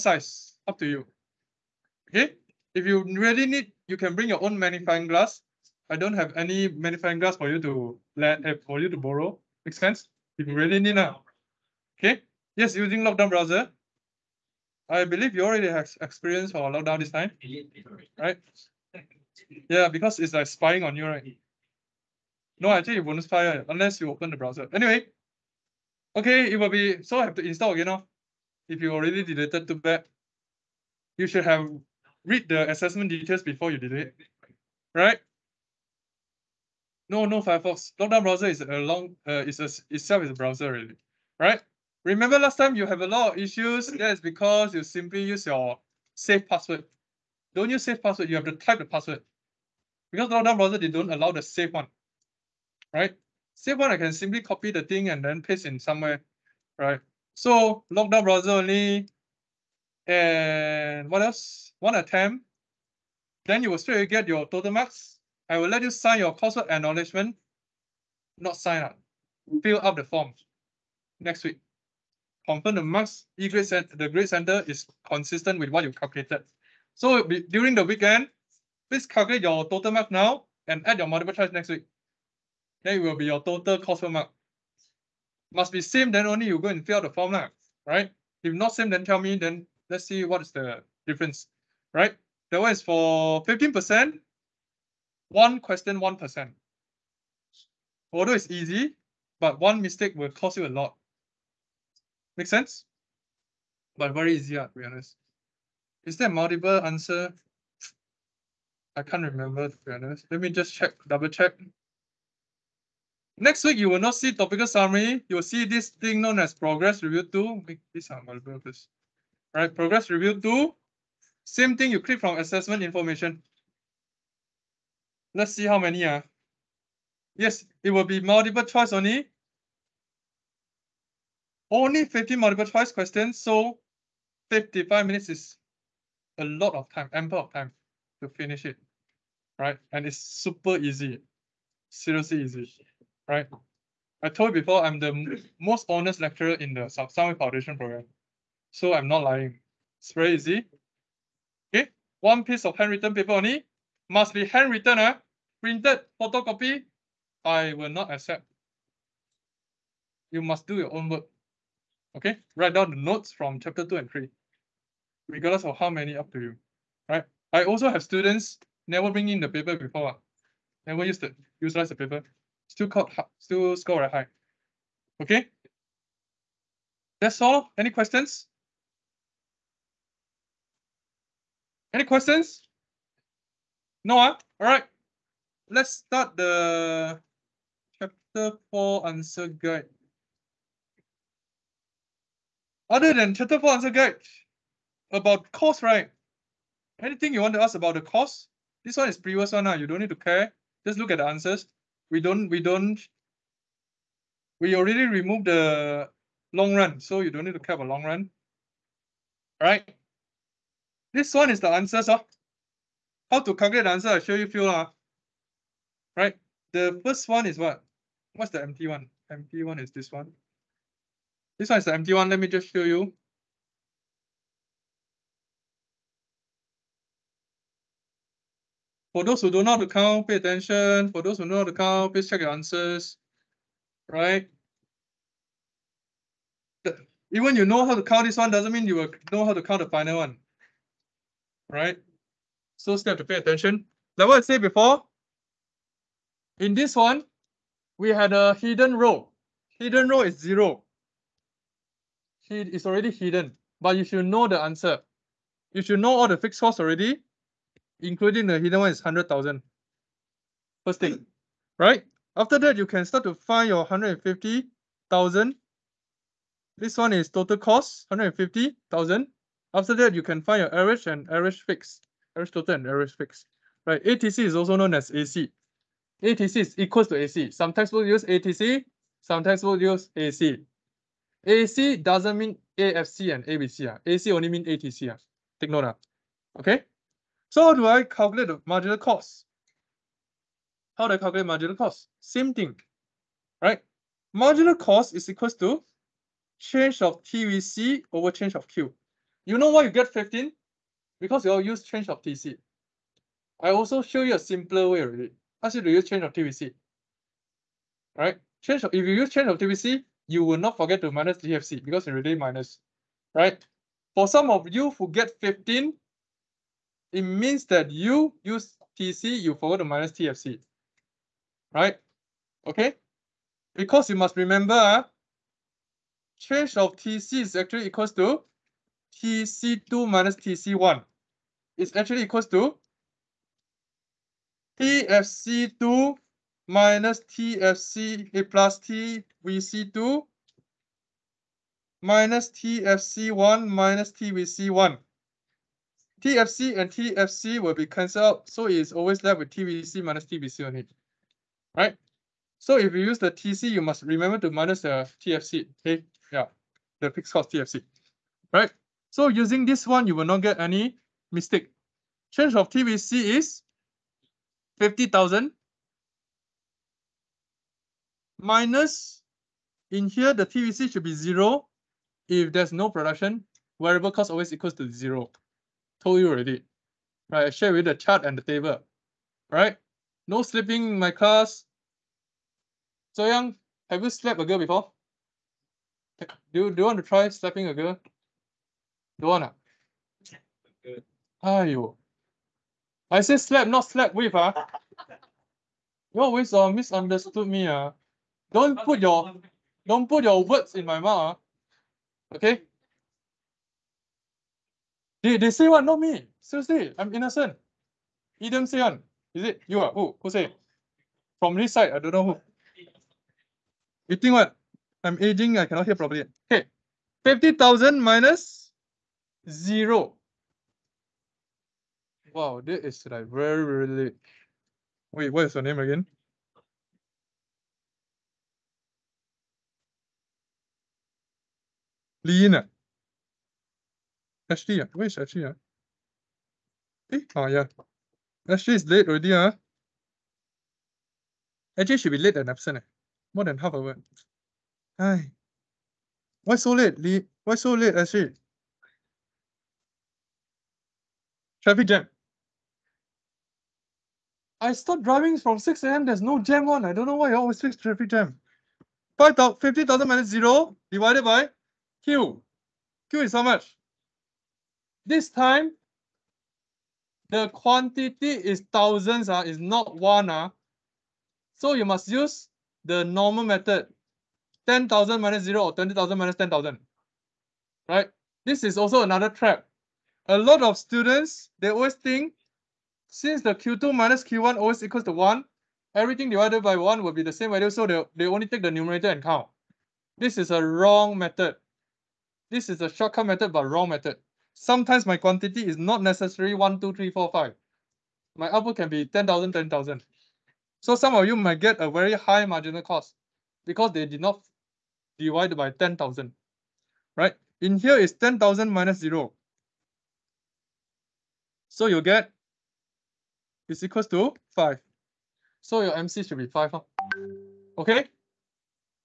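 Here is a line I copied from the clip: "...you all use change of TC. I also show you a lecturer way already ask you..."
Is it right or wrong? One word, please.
wrong.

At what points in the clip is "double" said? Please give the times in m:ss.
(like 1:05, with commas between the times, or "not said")
1:51.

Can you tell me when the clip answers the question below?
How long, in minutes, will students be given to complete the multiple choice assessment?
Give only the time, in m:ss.
2:14.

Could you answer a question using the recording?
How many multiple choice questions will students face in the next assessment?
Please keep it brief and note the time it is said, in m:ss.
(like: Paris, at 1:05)
50, at 2:12.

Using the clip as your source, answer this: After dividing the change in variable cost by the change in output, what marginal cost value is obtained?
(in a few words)
5.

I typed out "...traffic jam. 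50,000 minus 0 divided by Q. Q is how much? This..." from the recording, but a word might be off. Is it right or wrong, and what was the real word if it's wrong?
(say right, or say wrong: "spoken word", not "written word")
right.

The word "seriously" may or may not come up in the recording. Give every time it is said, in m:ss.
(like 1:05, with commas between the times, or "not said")
2:21, 6:46.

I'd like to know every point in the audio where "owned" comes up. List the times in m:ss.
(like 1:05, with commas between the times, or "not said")
not said.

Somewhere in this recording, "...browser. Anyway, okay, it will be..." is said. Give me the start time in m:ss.
0:24.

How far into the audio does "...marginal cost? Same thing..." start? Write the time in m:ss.
4:51.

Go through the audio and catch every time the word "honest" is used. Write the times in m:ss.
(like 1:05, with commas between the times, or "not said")
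1:44, 1:49, 2:25.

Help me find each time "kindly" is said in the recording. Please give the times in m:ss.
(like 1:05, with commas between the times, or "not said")
not said.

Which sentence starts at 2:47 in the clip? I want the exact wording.
I also have students never bring in the paper before, ah.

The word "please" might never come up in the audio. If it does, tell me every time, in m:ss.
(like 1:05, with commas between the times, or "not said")
1:18, 1:58, 3:52.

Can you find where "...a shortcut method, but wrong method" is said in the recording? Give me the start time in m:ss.
8:12.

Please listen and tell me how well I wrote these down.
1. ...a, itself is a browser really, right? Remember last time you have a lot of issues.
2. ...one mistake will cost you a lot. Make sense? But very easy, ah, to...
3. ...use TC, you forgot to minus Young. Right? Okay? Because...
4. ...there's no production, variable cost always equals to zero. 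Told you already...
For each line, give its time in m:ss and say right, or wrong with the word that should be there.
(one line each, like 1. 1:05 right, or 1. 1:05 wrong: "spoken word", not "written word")
1. 0:39 right
2. 1:39 right
3. 5:18 wrong: "TFC", not "Young"
4. 6:12 right.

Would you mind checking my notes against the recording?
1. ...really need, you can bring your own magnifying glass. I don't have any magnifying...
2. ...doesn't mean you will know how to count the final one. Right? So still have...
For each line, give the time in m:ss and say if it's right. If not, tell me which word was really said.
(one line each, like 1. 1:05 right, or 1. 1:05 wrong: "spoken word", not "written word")
1. 0:03 right
2. 3:58 right.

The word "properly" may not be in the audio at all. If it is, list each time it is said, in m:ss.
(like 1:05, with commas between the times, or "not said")
6:55.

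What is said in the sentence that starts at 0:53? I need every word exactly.
Safe one I can simply copy the thing and then paste in somewhere, right?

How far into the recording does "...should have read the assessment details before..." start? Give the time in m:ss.
0:31.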